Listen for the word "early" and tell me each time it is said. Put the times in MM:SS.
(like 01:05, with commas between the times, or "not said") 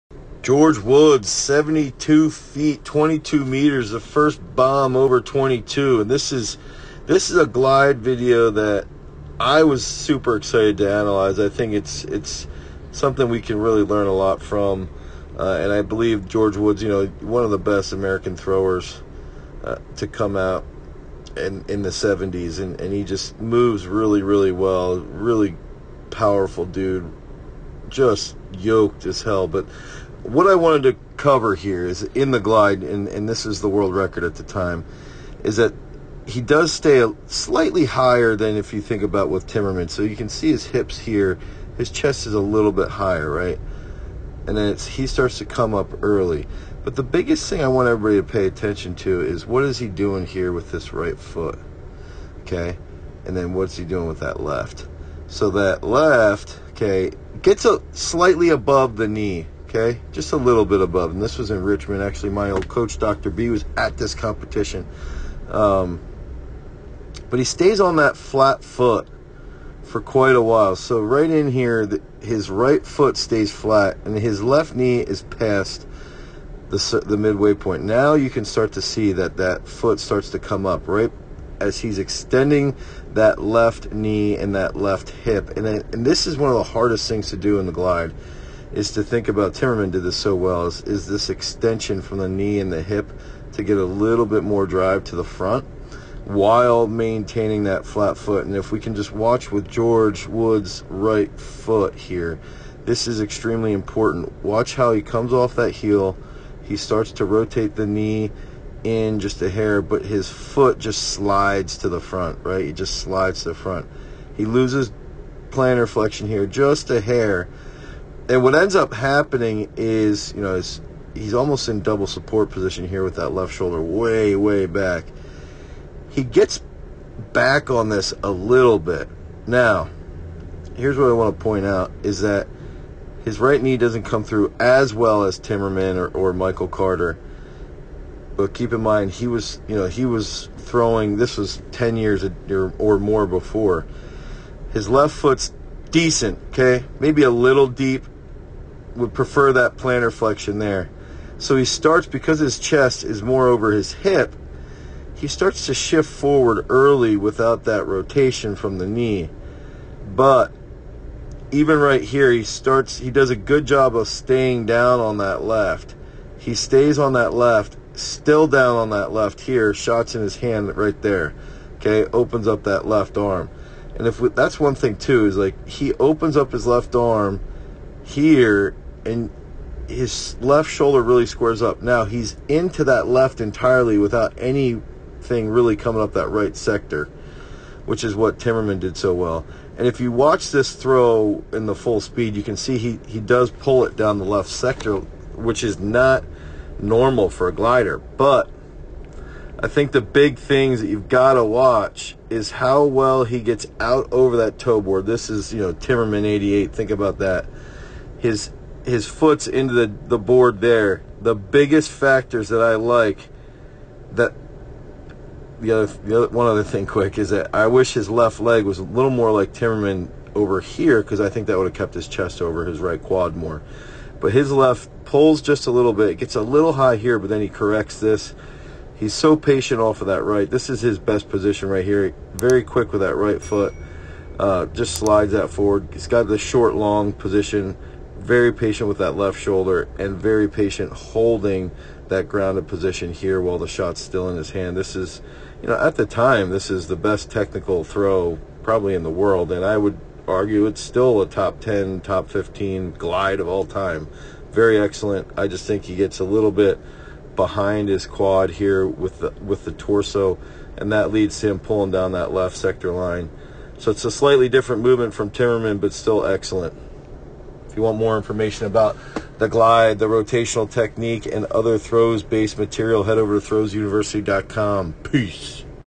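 00:46, 02:36.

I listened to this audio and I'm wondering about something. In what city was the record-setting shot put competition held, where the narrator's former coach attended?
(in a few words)
Richmond.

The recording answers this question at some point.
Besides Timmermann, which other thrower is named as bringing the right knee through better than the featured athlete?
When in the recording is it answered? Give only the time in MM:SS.
02:16.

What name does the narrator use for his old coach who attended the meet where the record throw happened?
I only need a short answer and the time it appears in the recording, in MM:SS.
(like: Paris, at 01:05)
Dr. B, at 01:02.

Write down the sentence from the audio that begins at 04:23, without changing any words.
So it's a slightly different movement from Timmermann, but still excellent.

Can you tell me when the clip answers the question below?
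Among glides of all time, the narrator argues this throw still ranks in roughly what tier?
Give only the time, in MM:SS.
04:11.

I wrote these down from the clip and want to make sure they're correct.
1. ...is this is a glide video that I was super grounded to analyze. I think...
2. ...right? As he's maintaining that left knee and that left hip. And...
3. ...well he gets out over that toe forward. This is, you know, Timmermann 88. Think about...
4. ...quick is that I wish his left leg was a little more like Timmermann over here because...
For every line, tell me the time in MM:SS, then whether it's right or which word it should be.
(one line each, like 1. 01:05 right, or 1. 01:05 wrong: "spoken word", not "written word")
1. 00:06 wrong: "excited", not "grounded"
2. 01:20 wrong: "extending", not "maintaining"
3. 03:22 wrong: "board", not "forward"
4. 03:36 right.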